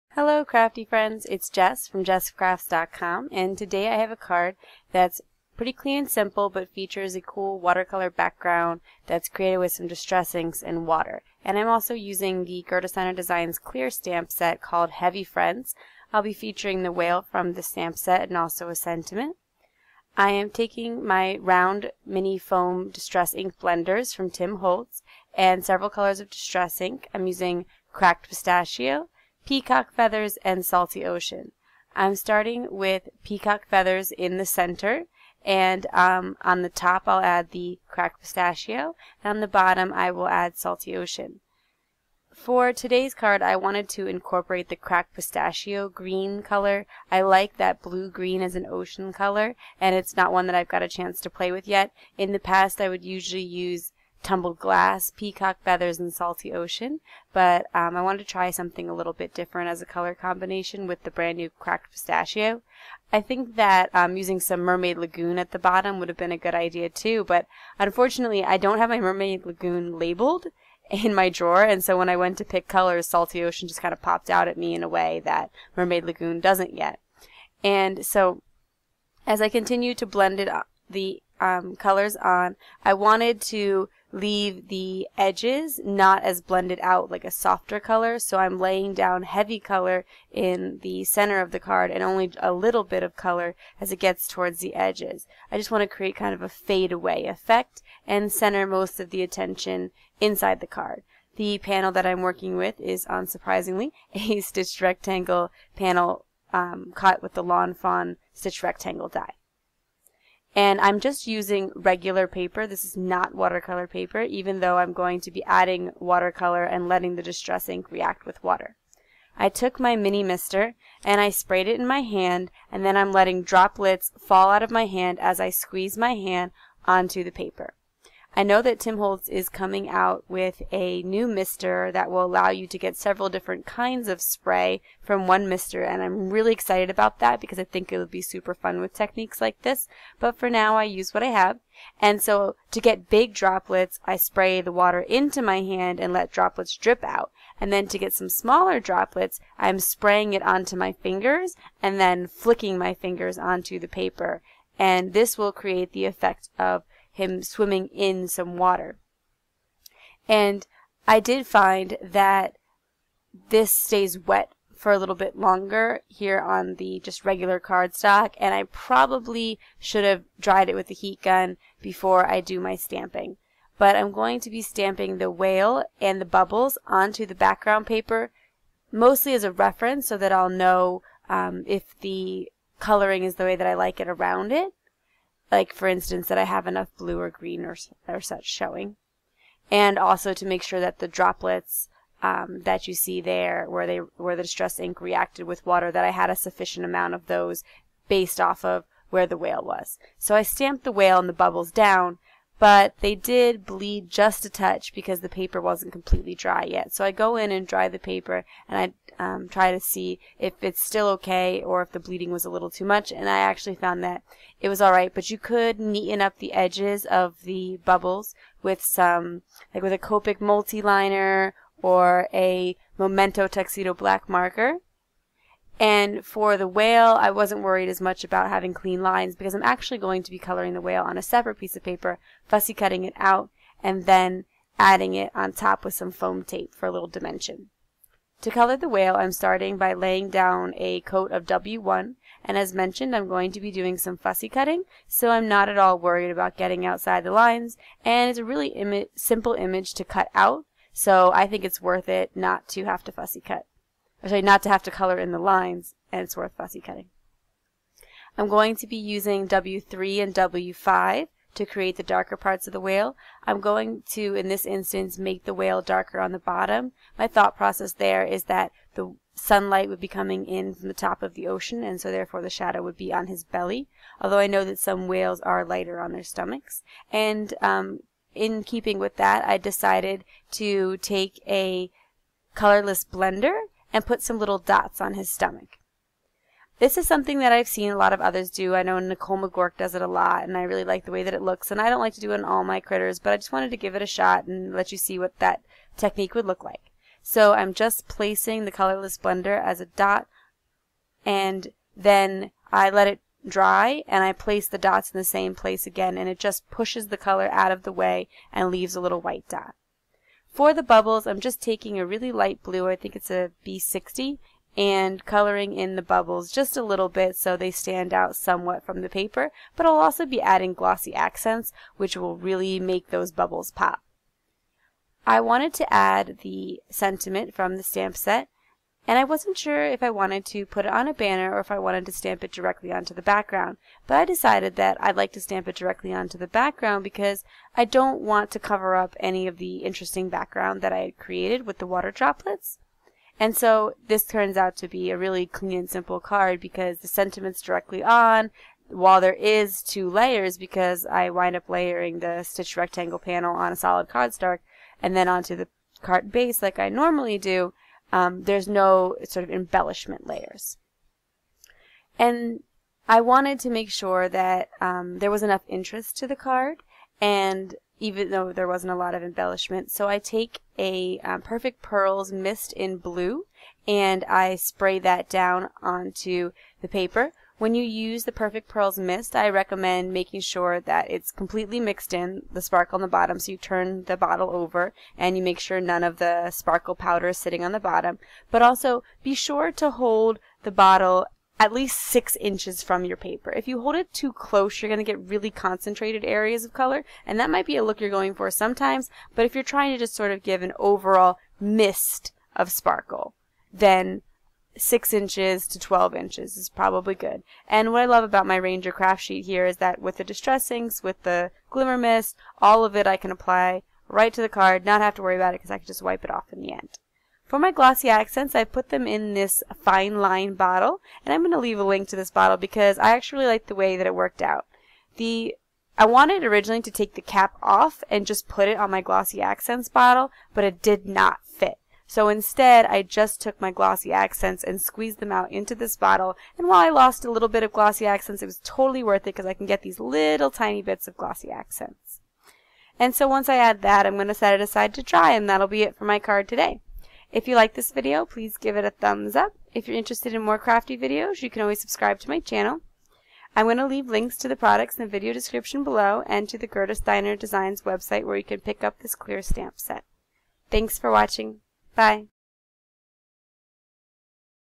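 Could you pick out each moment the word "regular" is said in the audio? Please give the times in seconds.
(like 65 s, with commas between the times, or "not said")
111 s, 167 s.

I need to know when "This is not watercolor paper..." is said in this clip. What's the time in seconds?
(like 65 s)
112 s.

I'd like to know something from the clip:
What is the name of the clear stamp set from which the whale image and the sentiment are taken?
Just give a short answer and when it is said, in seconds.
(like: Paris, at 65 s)
Heavy Friends, at 14 s.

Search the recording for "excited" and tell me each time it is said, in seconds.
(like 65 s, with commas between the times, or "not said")
136 s.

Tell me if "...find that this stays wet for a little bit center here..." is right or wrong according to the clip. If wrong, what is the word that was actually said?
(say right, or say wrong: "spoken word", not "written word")
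wrong: "longer", not "center".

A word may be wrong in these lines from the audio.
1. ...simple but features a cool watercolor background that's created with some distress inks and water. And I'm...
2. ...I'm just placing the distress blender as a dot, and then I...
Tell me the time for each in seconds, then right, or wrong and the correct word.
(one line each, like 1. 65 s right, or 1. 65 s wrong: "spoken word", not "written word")
1. 6 s right
2. 297 s wrong: "colorless", not "distress".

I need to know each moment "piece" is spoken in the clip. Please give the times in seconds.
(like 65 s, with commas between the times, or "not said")
231 s.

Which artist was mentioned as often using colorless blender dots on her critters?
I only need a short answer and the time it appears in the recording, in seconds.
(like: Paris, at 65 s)
Nichol Magouirk, at 288 s.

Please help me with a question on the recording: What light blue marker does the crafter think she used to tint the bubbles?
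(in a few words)
B60.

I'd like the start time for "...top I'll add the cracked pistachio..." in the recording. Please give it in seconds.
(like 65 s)
36 s.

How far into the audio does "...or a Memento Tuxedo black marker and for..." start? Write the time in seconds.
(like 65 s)
221 s.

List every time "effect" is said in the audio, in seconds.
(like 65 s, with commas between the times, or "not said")
97 s, 156 s.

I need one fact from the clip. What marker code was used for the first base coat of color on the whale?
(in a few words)
W1.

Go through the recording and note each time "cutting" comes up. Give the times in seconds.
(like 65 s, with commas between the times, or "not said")
232 s, 244 s, 256 s.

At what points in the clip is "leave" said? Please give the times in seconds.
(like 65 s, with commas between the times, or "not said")
84 s, 308 s, 421 s, 453 s.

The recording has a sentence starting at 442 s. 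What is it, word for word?
And so once I add that, I'm going to set it aside to dry, and that'll be it for my card today.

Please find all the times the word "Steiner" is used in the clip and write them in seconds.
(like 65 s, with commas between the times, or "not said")
12 s, 456 s.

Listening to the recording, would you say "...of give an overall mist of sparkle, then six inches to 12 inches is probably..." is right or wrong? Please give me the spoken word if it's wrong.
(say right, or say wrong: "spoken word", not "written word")
right.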